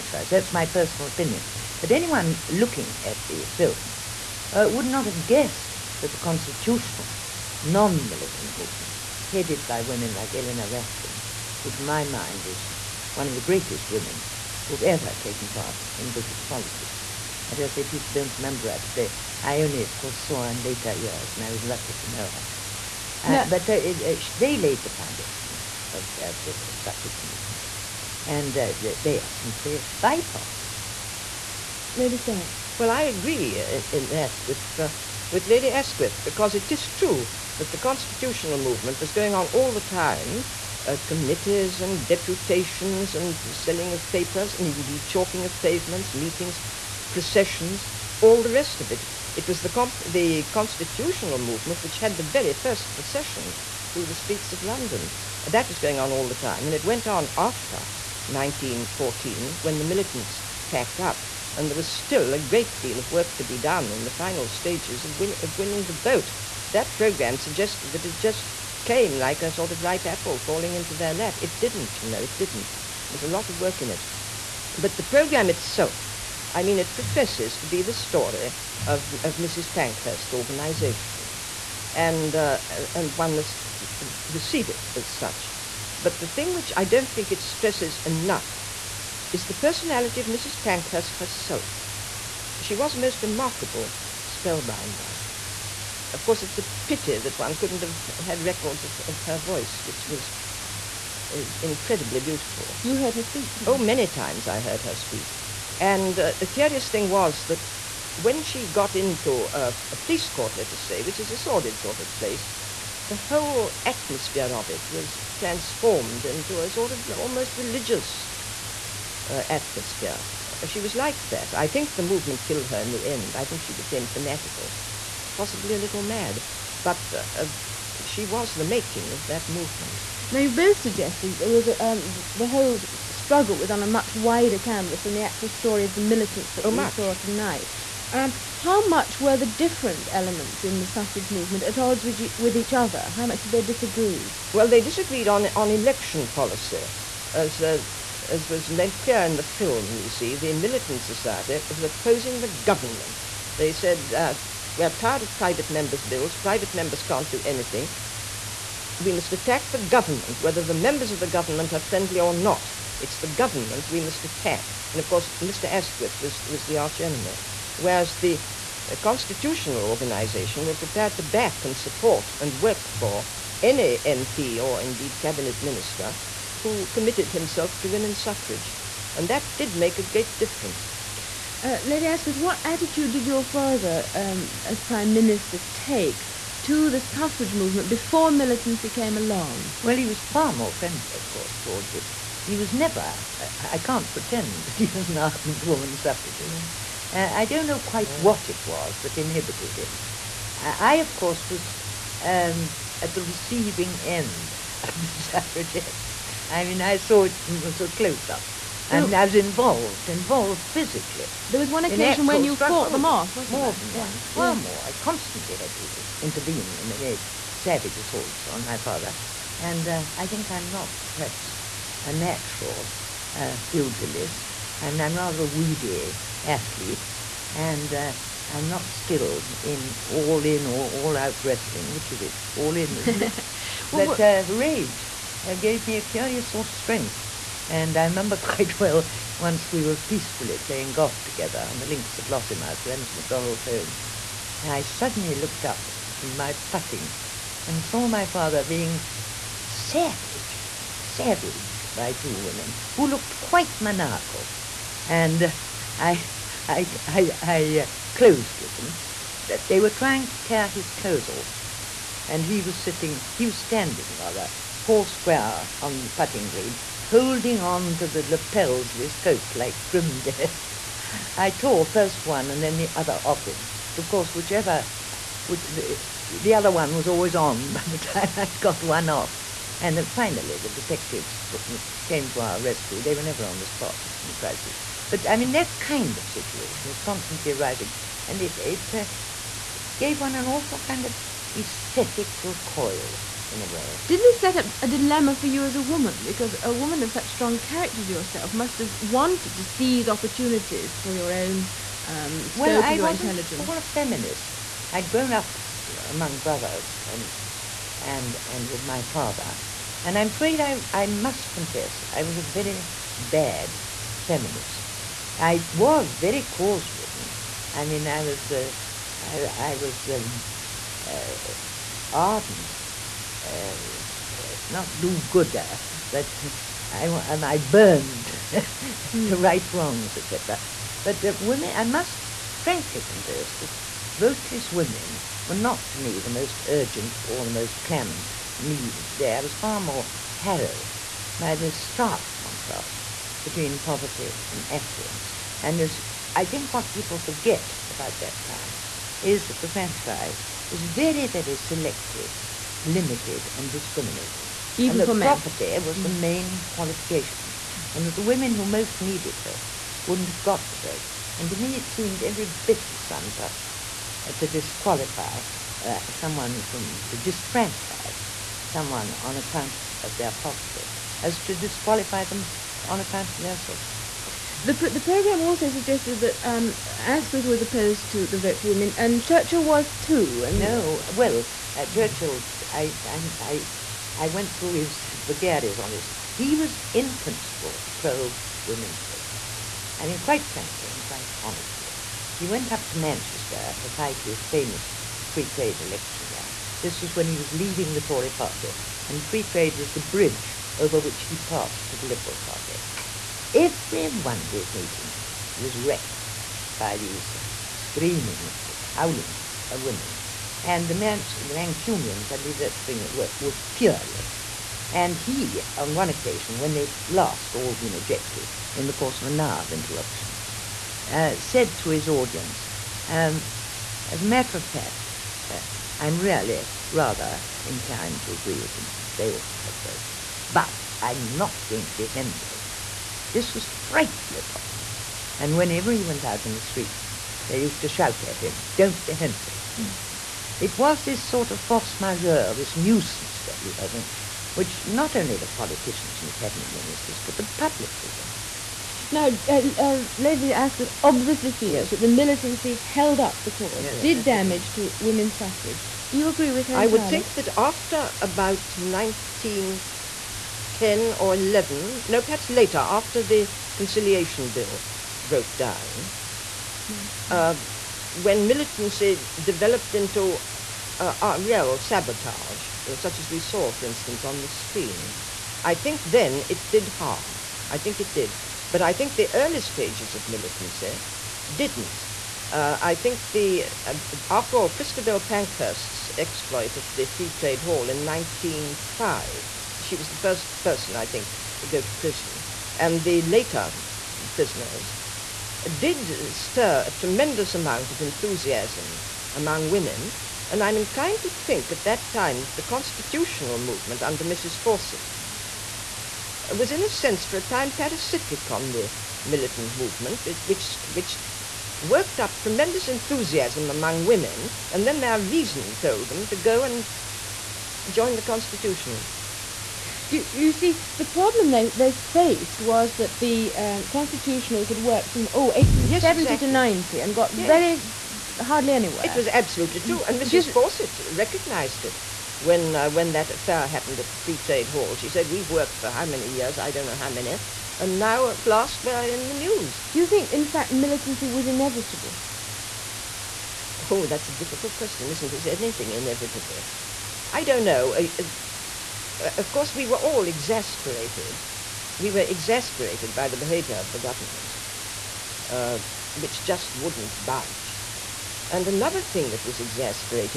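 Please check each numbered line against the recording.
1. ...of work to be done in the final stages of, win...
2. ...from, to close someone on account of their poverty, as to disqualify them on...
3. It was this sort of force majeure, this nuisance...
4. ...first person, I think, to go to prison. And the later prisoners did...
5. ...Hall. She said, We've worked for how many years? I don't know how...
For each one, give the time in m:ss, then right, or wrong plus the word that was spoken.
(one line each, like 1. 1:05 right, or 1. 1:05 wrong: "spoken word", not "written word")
1. 1:02 right
2. 6:06 wrong: "disfranchise", not "close"
3. 7:20 right
4. 8:10 right
5. 8:54 right.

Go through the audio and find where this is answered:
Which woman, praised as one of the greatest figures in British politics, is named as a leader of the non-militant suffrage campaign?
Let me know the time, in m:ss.
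0:10.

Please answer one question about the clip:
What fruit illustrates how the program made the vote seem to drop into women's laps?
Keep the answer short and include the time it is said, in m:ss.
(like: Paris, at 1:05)
Apple, at 1:09.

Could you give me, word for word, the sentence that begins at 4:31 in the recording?
I tore first one and then the other off him.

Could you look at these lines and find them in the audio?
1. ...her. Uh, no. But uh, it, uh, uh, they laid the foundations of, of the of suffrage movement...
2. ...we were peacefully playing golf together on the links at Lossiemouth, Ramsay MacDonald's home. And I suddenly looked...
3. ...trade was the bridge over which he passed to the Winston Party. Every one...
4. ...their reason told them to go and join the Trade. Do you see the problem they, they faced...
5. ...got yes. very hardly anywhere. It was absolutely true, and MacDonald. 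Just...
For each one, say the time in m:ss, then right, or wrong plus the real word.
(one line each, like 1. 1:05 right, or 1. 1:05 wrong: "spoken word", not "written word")
1. 0:22 right
2. 3:59 right
3. 6:39 wrong: "Liberal", not "Winston"
4. 8:35 wrong: "Constitutionals", not "Trade"
5. 8:47 wrong: "Mrs", not "MacDonald".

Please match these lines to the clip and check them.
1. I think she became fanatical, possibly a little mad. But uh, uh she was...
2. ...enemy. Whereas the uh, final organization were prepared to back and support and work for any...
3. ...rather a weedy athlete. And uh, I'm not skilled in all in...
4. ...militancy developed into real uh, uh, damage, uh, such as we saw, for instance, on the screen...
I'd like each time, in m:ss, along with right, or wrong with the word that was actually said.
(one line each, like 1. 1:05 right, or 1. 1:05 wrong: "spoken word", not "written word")
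1. 2:03 right
2. 2:47 wrong: "constitutional", not "final"
3. 3:45 right
4. 7:48 wrong: "sabotage", not "damage".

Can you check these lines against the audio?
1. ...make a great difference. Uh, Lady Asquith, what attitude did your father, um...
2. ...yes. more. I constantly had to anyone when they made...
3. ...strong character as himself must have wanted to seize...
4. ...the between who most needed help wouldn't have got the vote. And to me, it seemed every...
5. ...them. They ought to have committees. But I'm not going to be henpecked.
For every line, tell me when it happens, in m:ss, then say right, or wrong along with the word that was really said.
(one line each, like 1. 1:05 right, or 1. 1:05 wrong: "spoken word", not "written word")
1. 2:59 right
2. 3:34 wrong: "intervene", not "anyone"
3. 4:57 wrong: "yourself", not "himself"
4. 5:58 wrong: "women", not "between"
5. 7:08 wrong: "votes", not "committees".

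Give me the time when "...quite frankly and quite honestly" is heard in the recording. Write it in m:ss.
6:30.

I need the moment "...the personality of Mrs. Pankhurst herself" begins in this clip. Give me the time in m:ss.
1:29.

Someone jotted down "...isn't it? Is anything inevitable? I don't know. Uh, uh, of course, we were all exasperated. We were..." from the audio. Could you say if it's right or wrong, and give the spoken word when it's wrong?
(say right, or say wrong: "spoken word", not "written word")
right.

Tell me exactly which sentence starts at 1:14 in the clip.
But the program itself, I mean, it professes to be the story of, of Mrs.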